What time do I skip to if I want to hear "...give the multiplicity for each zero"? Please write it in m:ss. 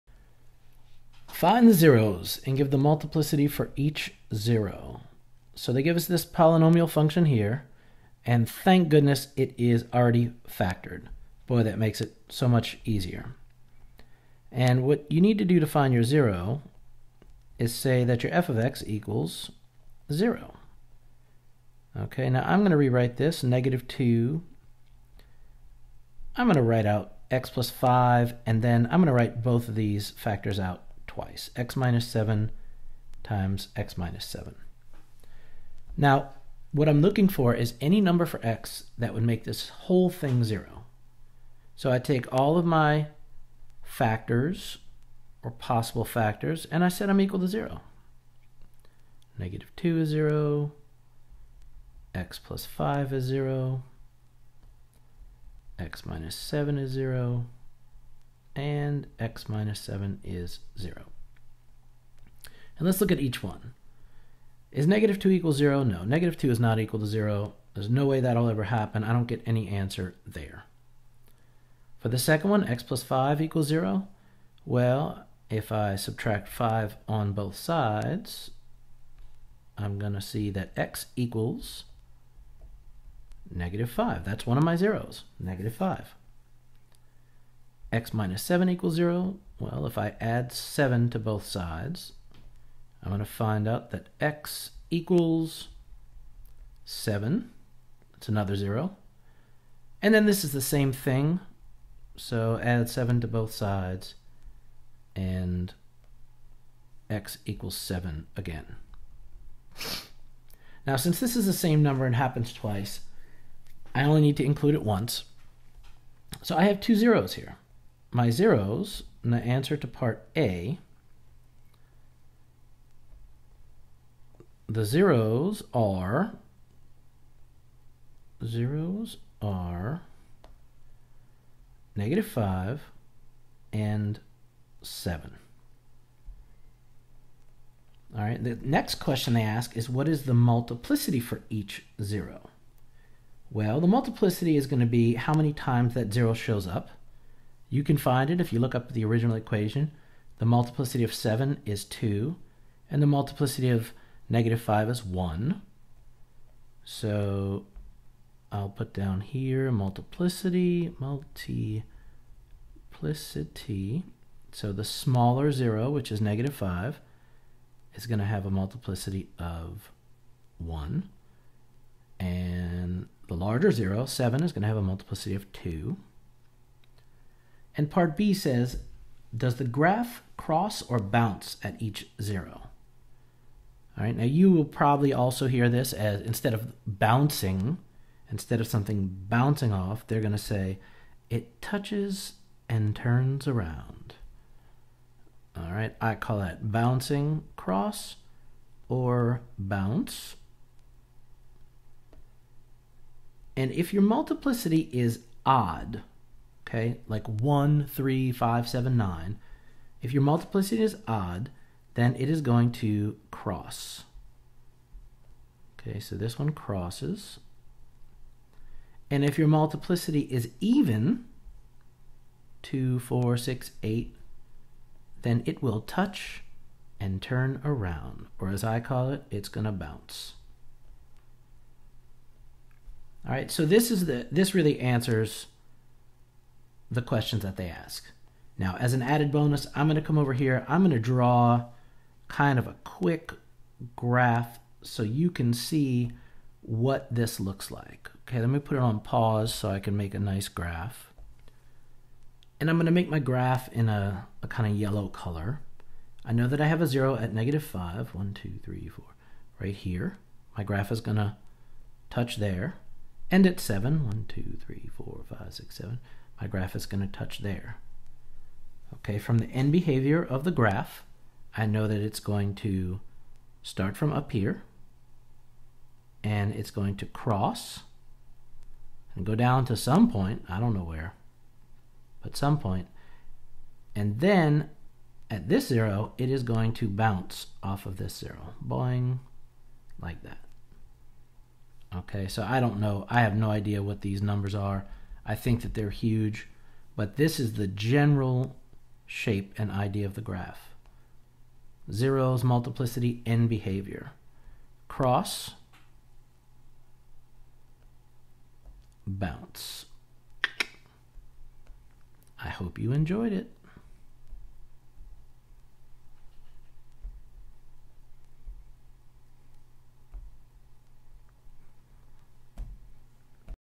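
0:02.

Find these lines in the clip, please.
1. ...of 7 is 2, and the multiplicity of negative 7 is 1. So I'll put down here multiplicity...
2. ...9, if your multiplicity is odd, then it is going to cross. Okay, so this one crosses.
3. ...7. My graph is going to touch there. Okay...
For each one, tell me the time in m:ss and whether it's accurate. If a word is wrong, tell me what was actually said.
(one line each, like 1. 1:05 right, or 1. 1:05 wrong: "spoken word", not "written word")
1. 2:31 wrong: "5", not "7"
2. 3:28 right
3. 4:25 right.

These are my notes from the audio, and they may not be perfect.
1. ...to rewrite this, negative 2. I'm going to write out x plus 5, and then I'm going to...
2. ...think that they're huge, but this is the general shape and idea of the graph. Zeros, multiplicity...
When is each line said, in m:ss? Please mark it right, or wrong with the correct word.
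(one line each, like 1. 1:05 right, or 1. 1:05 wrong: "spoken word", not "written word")
1. 0:22 right
2. 4:55 right.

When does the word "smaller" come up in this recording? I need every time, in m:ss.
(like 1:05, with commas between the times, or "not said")
2:44.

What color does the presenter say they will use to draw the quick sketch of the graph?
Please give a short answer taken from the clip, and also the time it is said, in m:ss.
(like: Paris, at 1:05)
yellow, at 4:14.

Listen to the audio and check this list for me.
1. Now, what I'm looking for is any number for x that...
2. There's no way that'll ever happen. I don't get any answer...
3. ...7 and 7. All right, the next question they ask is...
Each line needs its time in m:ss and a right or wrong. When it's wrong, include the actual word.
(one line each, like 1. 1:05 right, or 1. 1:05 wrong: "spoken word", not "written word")
1. 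0:35 right
2. 1:07 right
3. 2:12 wrong: "5", not "7".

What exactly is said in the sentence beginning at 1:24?
That's one of my zeros, negative 5 x minus 7 equals 0?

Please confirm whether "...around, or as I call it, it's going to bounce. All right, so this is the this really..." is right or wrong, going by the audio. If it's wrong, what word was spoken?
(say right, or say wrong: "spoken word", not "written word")
right.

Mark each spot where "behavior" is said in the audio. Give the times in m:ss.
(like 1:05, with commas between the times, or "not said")
4:29, 5:03.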